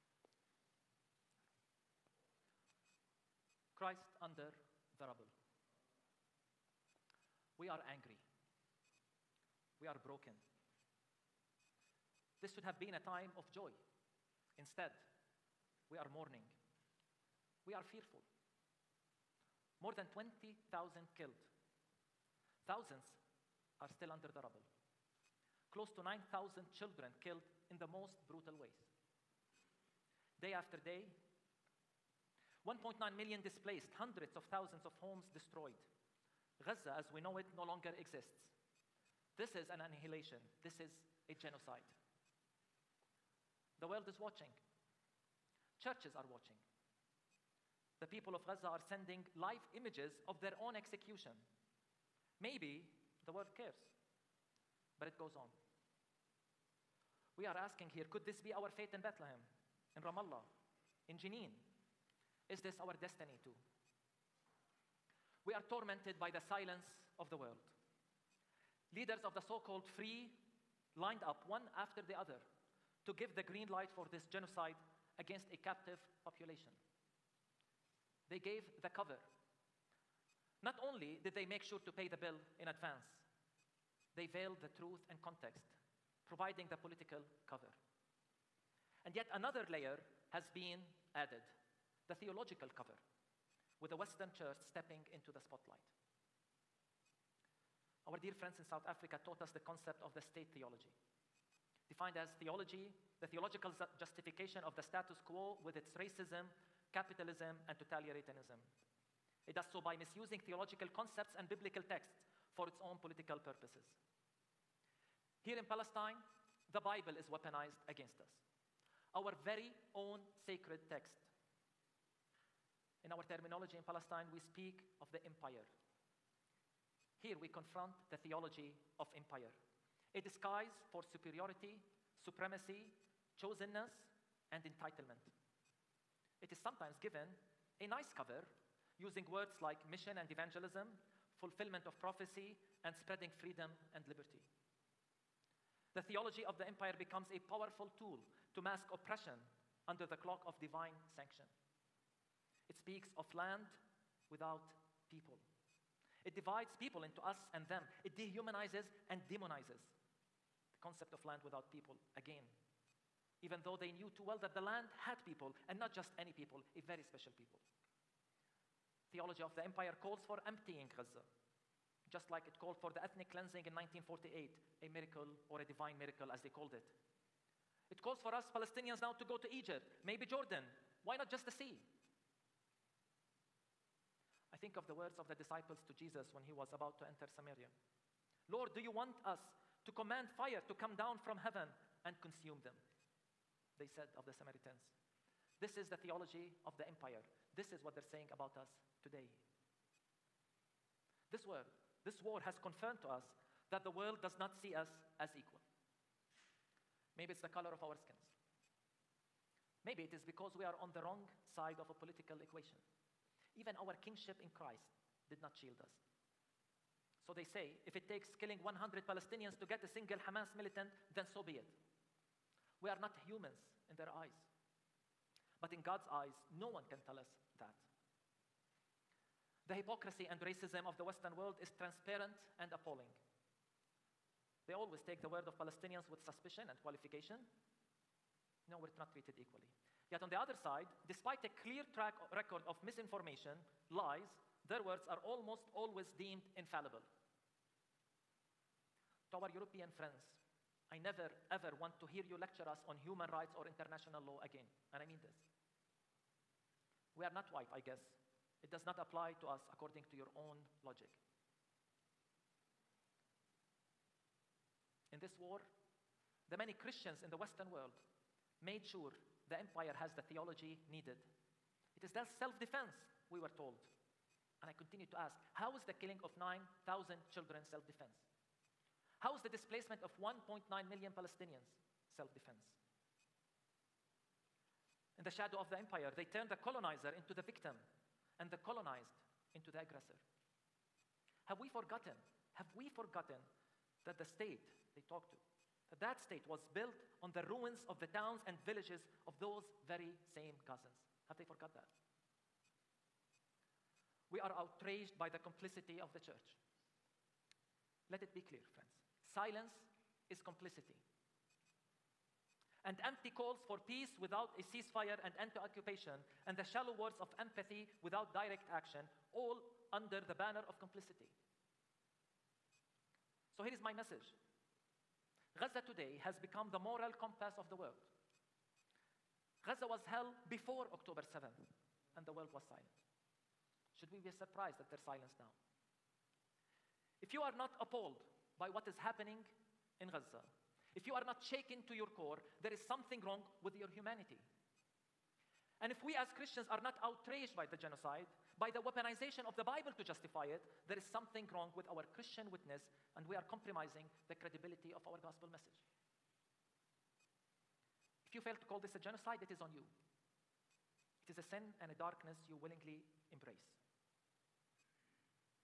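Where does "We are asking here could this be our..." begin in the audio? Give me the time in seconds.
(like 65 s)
57 s.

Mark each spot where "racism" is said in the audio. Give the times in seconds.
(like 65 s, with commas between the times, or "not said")
105 s, 230 s.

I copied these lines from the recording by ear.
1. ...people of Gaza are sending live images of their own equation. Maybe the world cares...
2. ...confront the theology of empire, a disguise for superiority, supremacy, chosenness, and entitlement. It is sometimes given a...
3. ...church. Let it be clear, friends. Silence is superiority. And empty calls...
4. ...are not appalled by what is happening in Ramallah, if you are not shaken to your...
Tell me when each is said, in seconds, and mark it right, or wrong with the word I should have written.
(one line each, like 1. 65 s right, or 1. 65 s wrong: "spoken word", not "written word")
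1. 48 s wrong: "execution", not "equation"
2. 127 s right
3. 306 s wrong: "complicity", not "superiority"
4. 337 s wrong: "Gaza", not "Ramallah".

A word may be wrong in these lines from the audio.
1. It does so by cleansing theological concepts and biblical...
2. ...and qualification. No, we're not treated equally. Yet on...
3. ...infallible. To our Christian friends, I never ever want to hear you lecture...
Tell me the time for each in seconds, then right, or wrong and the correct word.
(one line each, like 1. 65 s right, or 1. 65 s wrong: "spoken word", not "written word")
1. 109 s wrong: "misusing", not "cleansing"
2. 236 s right
3. 246 s wrong: "European", not "Christian".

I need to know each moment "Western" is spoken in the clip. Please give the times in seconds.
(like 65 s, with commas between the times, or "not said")
93 s, 231 s, 267 s.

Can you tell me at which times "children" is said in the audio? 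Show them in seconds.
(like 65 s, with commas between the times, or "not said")
26 s, 277 s.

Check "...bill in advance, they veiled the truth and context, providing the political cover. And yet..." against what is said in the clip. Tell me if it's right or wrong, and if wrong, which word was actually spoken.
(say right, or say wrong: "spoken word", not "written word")
right.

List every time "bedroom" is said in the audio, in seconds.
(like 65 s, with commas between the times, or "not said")
not said.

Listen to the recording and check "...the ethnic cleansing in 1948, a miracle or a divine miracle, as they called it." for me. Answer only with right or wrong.
right.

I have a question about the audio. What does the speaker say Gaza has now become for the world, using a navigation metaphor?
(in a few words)
the moral compass.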